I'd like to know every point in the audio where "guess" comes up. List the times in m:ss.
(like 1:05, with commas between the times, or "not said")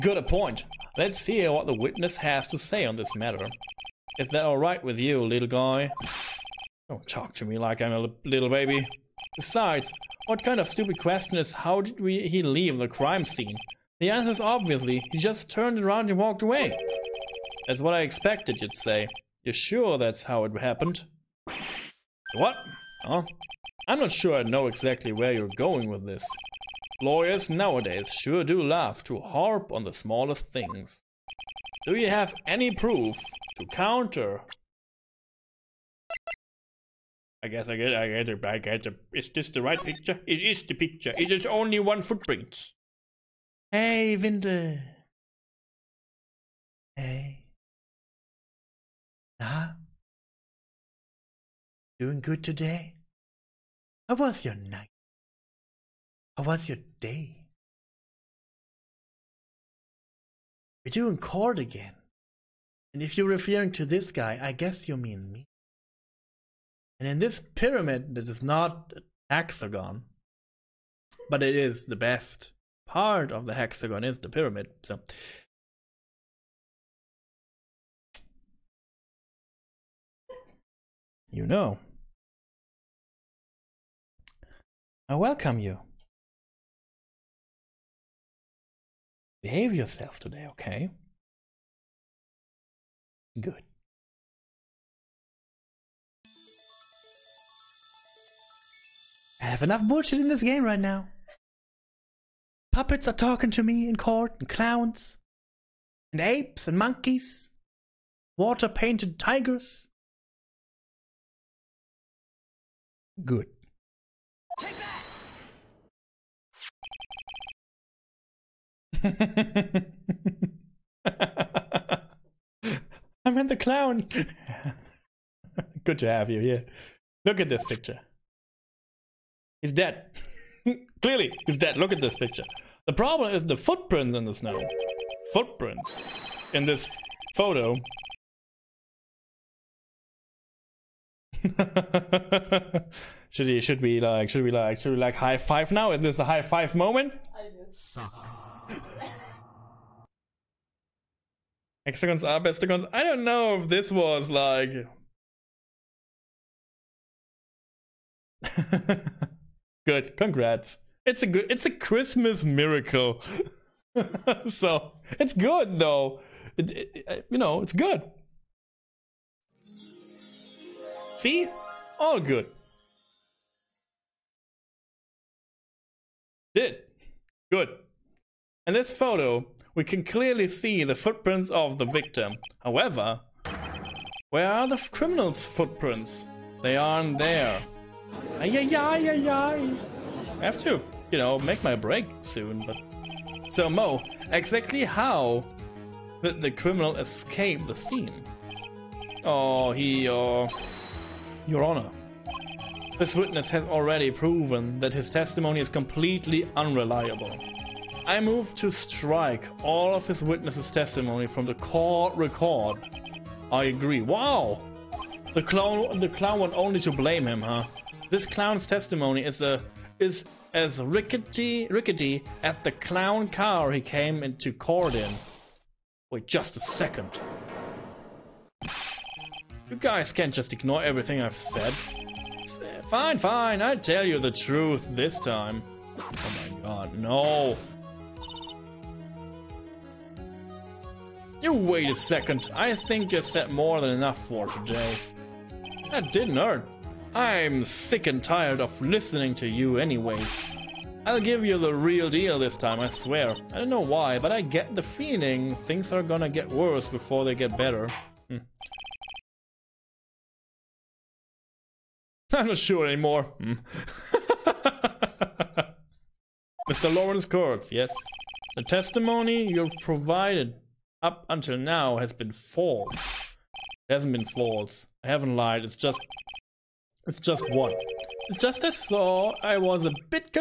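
0:37, 1:04, 2:27.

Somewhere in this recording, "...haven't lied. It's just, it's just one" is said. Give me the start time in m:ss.
4:35.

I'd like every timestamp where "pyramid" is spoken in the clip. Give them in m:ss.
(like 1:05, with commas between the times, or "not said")
1:07, 1:14.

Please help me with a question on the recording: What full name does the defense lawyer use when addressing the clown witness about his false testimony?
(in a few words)
Lawrence Curls.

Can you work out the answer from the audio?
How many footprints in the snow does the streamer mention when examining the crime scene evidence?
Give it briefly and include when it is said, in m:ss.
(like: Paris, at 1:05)
1, at 0:41.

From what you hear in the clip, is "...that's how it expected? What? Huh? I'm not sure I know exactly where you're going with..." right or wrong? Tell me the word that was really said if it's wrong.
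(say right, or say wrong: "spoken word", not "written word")
wrong: "happened", not "expected".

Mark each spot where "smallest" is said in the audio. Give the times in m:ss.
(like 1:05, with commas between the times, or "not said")
0:29.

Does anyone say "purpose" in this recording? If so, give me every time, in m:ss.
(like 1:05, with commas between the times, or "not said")
not said.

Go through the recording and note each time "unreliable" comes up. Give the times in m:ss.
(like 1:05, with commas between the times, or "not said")
3:26.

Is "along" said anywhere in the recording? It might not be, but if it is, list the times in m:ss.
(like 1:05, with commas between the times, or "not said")
not said.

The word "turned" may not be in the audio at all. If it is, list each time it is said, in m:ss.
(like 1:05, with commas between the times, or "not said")
0:15.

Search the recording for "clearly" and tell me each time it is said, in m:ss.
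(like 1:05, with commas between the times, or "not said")
2:11, 3:00.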